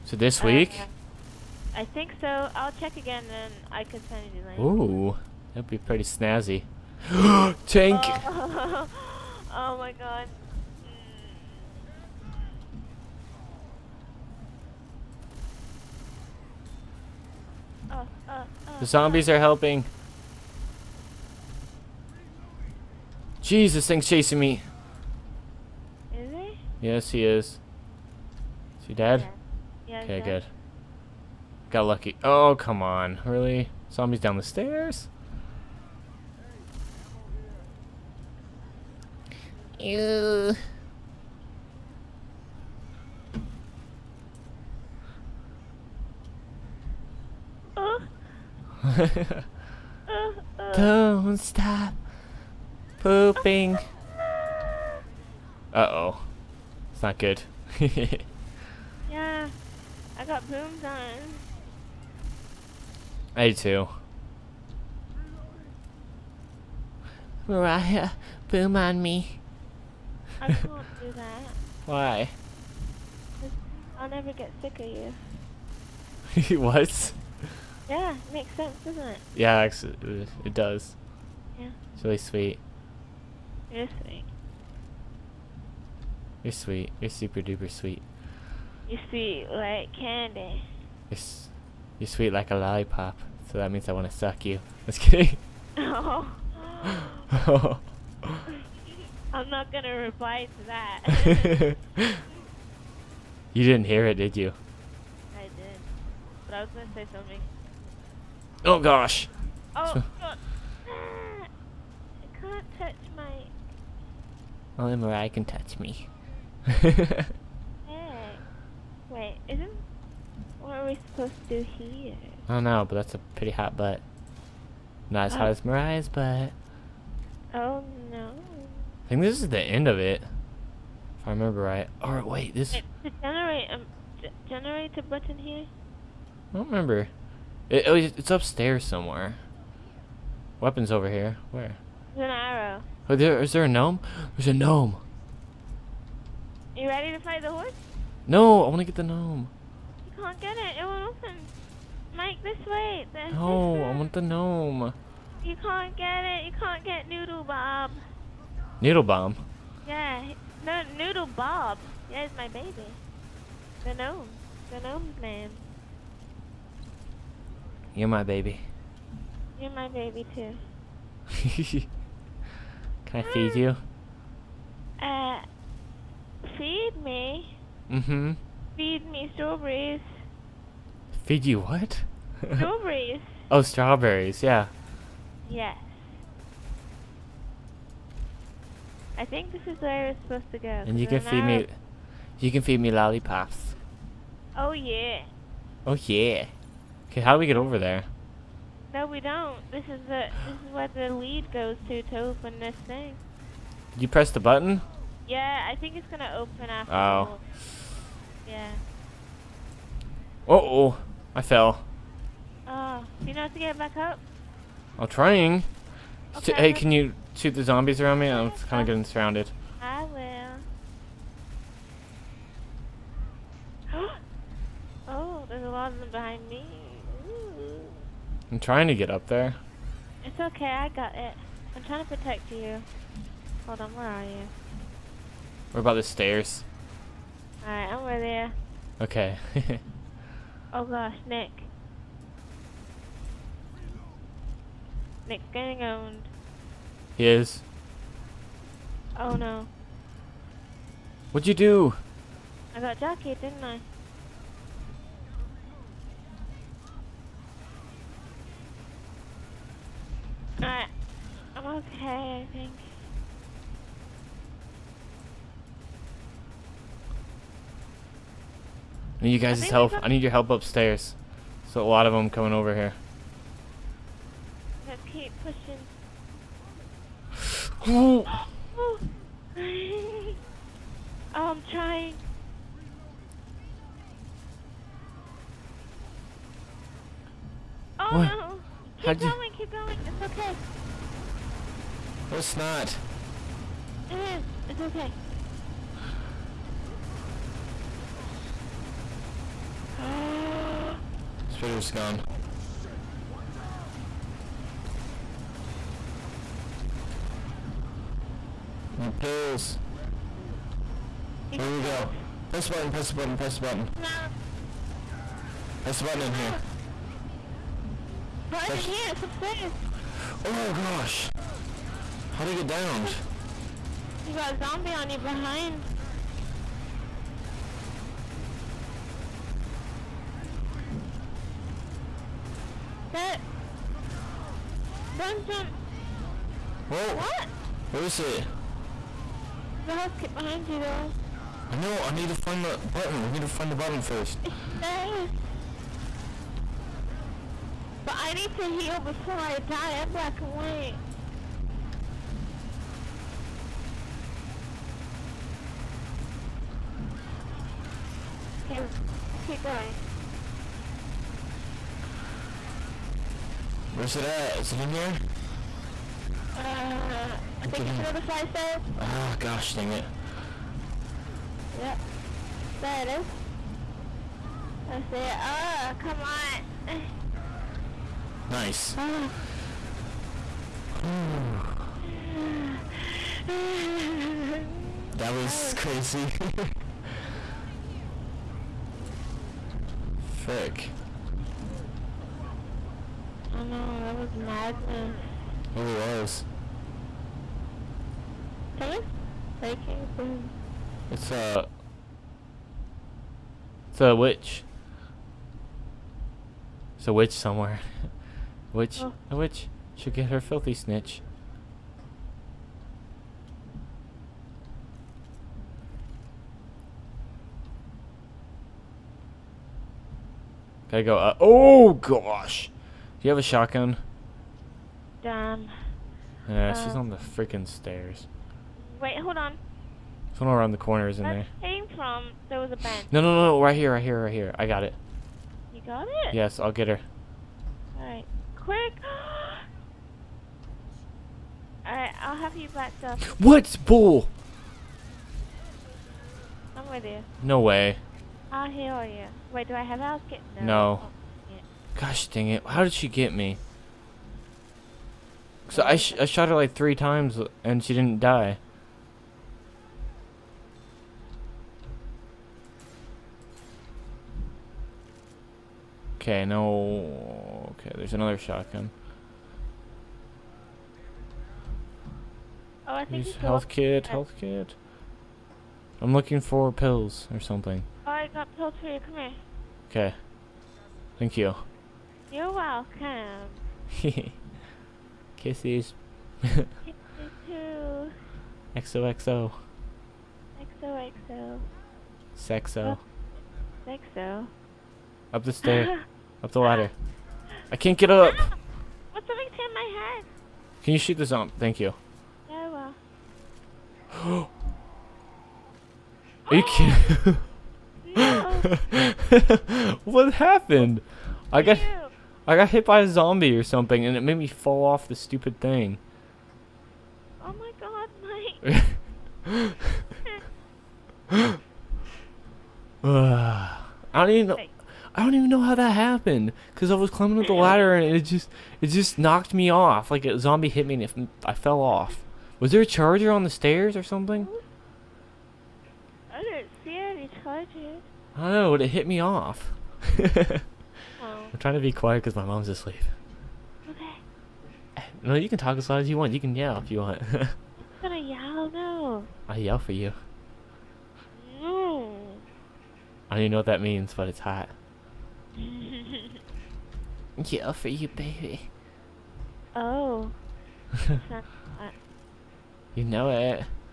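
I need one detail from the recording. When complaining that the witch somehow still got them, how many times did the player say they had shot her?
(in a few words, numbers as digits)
3.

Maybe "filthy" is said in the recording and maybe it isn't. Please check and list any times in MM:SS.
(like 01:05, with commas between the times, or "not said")
06:50.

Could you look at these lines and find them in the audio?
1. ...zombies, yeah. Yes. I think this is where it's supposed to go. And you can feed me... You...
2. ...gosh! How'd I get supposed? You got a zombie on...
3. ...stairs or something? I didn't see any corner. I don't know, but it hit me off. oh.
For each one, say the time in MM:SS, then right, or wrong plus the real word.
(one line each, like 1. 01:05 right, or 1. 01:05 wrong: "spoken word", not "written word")
1. 03:03 wrong: "strawberries", not "zombies"
2. 05:20 wrong: "downed", not "supposed"
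3. 08:53 wrong: "charger", not "corner".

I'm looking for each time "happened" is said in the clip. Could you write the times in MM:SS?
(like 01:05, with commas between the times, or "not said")
08:30, 08:45.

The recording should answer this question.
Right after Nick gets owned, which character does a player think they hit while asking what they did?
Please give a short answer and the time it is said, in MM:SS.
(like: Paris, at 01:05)
Jackie, at 04:12.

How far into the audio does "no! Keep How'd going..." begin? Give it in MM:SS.
04:48.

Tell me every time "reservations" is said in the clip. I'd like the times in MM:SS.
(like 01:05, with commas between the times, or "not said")
not said.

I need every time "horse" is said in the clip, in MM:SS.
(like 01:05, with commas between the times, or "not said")
02:27.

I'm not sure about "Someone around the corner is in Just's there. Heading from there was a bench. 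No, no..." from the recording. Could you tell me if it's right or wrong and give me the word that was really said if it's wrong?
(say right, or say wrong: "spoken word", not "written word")
wrong: "That", not "Just".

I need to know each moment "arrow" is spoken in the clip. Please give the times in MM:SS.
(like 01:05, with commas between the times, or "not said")
02:22.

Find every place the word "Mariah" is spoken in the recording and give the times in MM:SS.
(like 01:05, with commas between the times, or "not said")
01:07, 01:54, 02:05.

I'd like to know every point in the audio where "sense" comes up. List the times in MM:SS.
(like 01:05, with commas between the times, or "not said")
01:18.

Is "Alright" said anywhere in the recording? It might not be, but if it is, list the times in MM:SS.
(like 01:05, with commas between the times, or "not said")
03:57, 04:20.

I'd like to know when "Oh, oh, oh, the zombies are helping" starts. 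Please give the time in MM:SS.
00:17.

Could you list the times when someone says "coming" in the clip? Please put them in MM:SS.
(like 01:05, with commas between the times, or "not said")
04:32, 06:38.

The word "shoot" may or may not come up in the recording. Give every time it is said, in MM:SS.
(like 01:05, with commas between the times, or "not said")
03:37, 08:20.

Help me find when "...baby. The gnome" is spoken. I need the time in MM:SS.
02:42.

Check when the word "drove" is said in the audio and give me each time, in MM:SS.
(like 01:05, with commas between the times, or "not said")
not said.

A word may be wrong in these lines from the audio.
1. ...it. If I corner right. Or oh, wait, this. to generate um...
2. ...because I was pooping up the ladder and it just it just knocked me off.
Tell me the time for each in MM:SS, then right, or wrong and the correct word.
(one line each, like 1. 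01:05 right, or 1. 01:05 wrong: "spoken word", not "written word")
1. 02:09 wrong: "remember", not "corner"
2. 08:46 wrong: "climbing", not "pooping".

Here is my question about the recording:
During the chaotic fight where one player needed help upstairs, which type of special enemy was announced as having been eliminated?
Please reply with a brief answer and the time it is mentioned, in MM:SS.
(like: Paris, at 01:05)
Spitter, at 05:01.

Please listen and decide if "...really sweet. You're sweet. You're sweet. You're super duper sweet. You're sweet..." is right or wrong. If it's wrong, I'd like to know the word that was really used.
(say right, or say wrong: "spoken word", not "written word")
right.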